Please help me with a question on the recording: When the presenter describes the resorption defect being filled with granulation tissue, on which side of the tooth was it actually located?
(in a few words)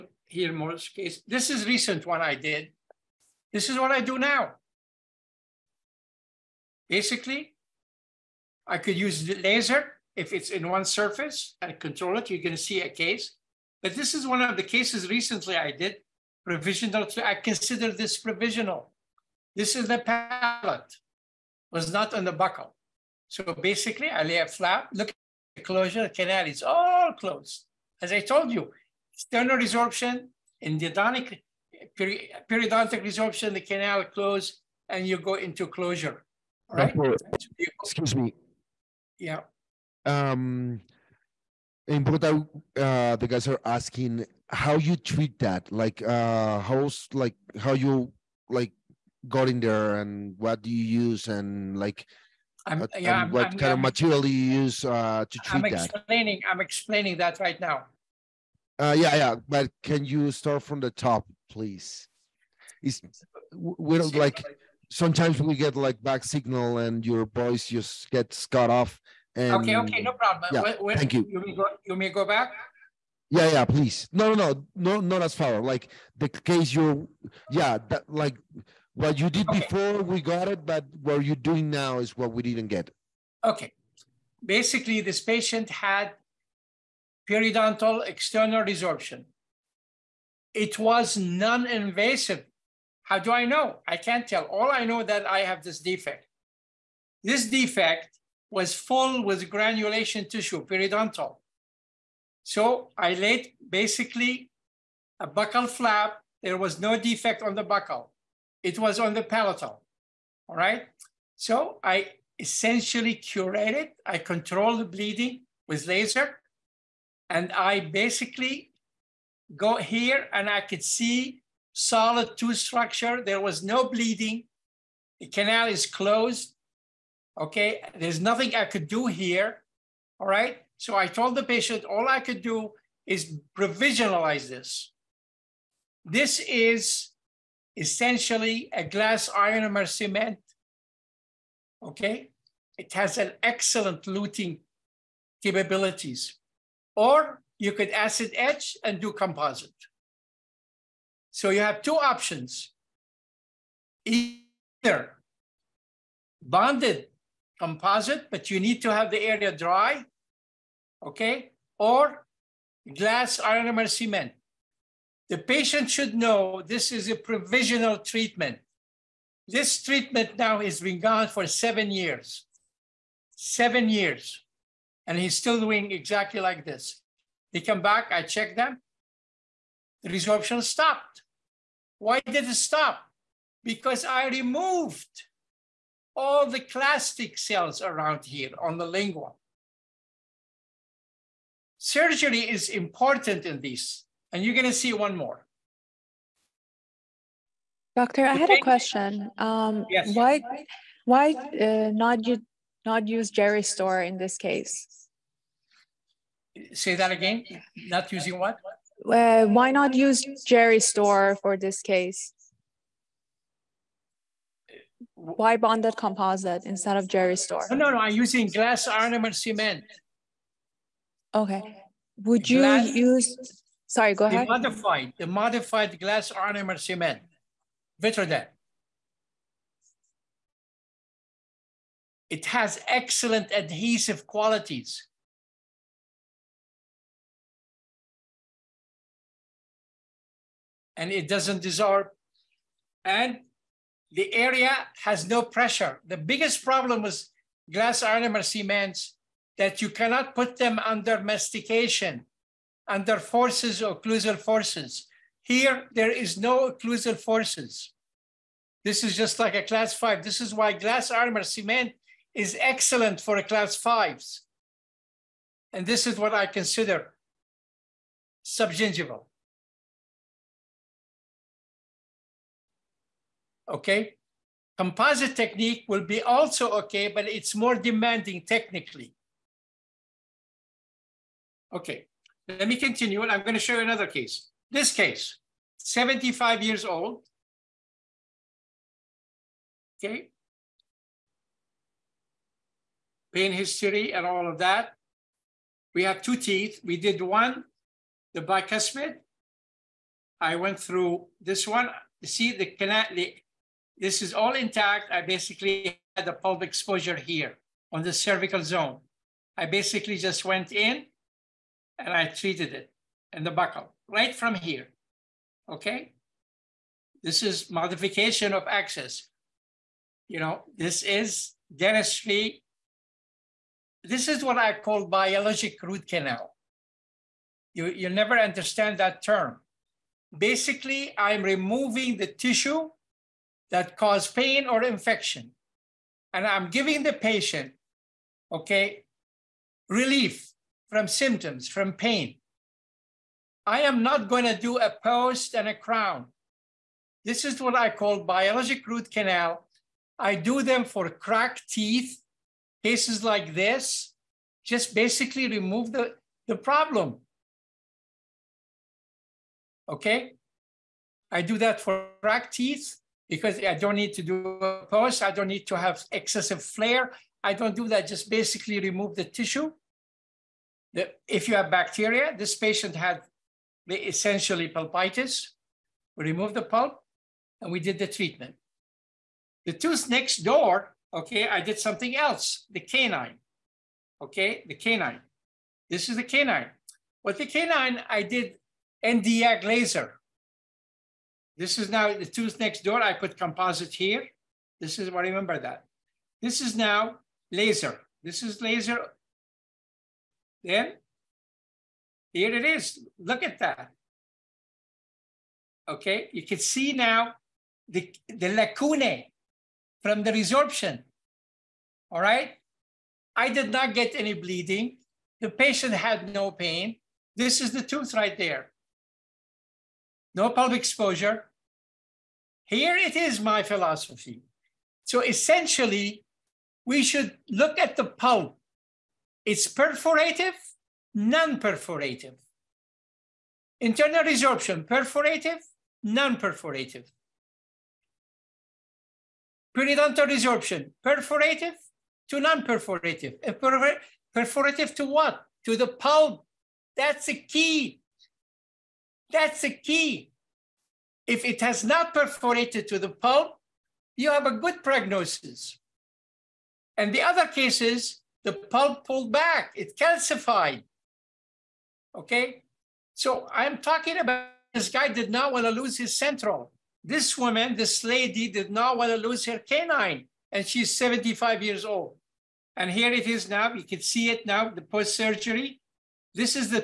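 Palatal.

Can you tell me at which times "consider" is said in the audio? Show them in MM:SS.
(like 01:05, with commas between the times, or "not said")
00:17, 04:26.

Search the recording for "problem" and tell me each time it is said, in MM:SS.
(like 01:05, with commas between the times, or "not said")
01:10, 04:06, 05:56.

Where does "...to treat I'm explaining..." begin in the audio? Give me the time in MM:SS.
00:55.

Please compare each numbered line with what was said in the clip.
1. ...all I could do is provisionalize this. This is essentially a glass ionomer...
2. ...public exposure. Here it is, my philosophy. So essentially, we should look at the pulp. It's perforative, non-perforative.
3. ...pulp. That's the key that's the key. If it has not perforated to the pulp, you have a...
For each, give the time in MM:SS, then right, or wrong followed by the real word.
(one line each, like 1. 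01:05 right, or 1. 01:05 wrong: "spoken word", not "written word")
1. 02:11 right
2. 07:00 right
3. 07:25 right.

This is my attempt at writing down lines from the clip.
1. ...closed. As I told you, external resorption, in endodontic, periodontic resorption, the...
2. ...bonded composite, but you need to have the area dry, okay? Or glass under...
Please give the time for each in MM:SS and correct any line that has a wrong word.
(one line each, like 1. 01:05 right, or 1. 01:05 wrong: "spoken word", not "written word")
1. 00:27 right
2. 02:36 wrong: "ionomer", not "under".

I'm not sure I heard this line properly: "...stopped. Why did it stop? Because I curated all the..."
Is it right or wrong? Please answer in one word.
wrong.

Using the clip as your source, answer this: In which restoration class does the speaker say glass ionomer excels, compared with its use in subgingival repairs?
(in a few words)
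Class five.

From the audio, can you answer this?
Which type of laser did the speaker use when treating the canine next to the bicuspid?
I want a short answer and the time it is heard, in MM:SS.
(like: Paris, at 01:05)
Nd:YAG laser, at 06:29.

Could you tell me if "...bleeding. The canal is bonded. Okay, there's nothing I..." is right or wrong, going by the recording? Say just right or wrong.
wrong.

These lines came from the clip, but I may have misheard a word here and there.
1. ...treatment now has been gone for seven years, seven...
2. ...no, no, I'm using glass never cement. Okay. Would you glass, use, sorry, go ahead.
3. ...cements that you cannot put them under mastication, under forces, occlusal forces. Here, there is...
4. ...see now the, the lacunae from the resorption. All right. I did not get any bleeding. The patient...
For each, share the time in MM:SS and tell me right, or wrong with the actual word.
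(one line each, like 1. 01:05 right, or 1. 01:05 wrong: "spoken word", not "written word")
1. 02:49 right
2. 03:37 wrong: "ionomer", not "never"
3. 04:08 right
4. 06:46 right.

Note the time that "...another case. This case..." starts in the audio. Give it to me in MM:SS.
04:43.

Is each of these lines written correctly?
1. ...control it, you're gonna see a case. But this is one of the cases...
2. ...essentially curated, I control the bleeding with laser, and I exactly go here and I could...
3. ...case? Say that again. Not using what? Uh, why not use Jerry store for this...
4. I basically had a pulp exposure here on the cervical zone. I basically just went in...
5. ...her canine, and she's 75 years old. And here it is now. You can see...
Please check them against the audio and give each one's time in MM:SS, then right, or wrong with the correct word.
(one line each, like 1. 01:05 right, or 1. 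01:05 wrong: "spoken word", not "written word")
1. 00:11 right
2. 01:52 wrong: "basically", not "exactly"
3. 03:24 right
4. 05:05 right
5. 07:49 right.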